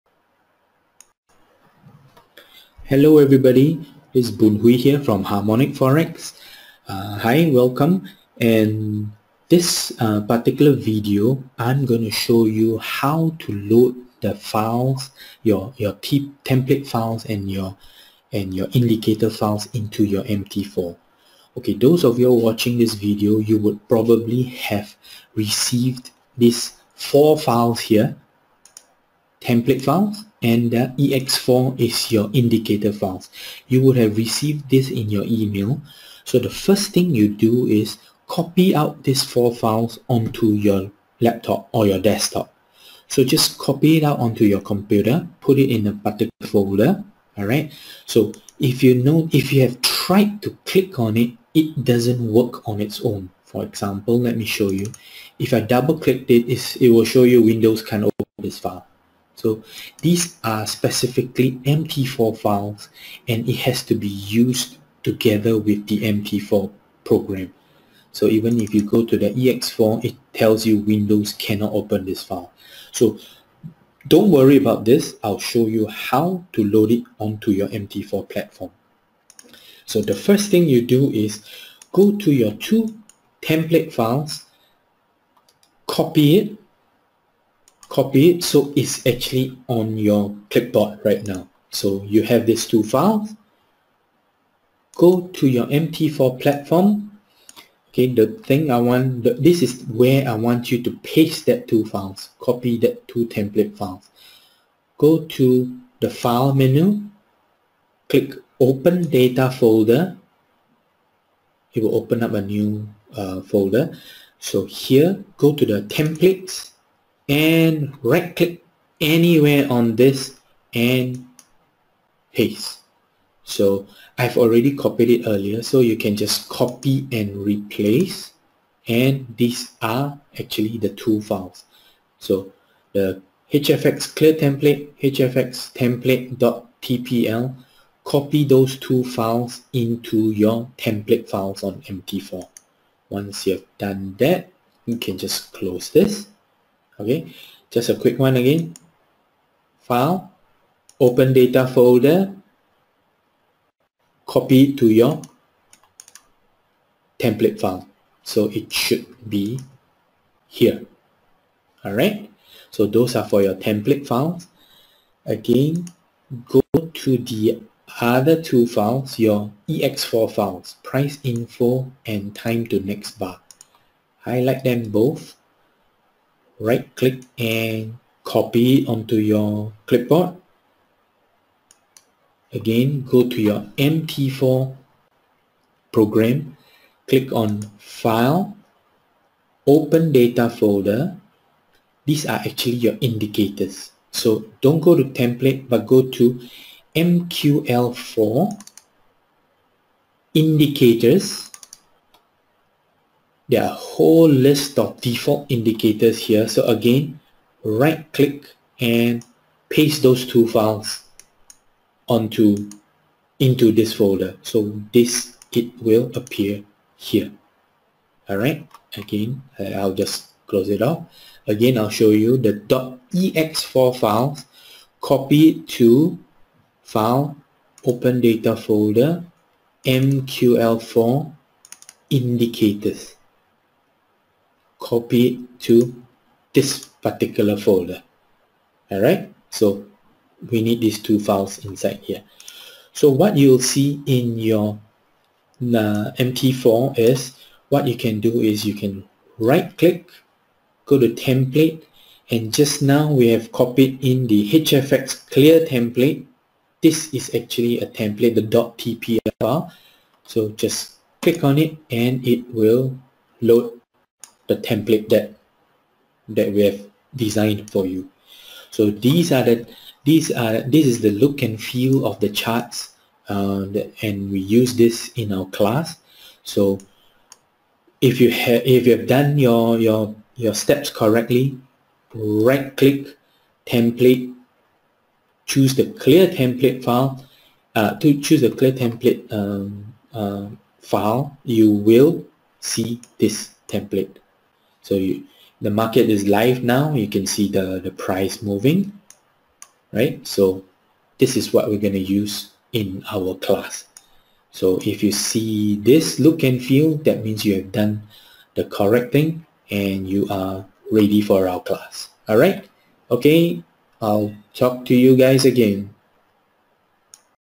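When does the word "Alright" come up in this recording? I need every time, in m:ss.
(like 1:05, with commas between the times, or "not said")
0:47, 3:38.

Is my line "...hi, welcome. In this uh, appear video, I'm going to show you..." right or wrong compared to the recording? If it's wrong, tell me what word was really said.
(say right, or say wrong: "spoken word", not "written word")
wrong: "particular", not "appear".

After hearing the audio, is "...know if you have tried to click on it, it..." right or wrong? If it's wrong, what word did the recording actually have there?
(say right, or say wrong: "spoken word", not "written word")
right.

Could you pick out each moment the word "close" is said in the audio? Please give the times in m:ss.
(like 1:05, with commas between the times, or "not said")
2:25, 3:40.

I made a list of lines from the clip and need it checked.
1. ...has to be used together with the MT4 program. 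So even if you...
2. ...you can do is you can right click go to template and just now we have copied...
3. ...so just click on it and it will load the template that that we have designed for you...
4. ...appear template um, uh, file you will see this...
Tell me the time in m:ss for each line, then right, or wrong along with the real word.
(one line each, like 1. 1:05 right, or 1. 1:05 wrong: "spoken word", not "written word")
1. 1:03 right
2. 4:07 right
3. 4:20 right
4. 4:48 wrong: "clear", not "appear".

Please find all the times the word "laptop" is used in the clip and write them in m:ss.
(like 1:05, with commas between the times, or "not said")
0:41.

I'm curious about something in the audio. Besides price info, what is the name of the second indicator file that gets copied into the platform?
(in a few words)
time to next bar.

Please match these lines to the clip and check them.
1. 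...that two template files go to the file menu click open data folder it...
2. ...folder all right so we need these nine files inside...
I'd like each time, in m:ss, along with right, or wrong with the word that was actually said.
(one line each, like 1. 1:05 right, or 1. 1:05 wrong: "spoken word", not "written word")
1. 1:42 right
2. 3:57 wrong: "two", not "nine".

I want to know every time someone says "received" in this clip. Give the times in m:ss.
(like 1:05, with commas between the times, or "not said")
0:25, 0:34.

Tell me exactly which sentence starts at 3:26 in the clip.
So again, right click and paste those two files onto into this folder.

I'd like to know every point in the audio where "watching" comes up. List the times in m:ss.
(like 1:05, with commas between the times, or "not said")
0:22.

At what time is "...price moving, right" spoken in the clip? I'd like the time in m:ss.
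4:57.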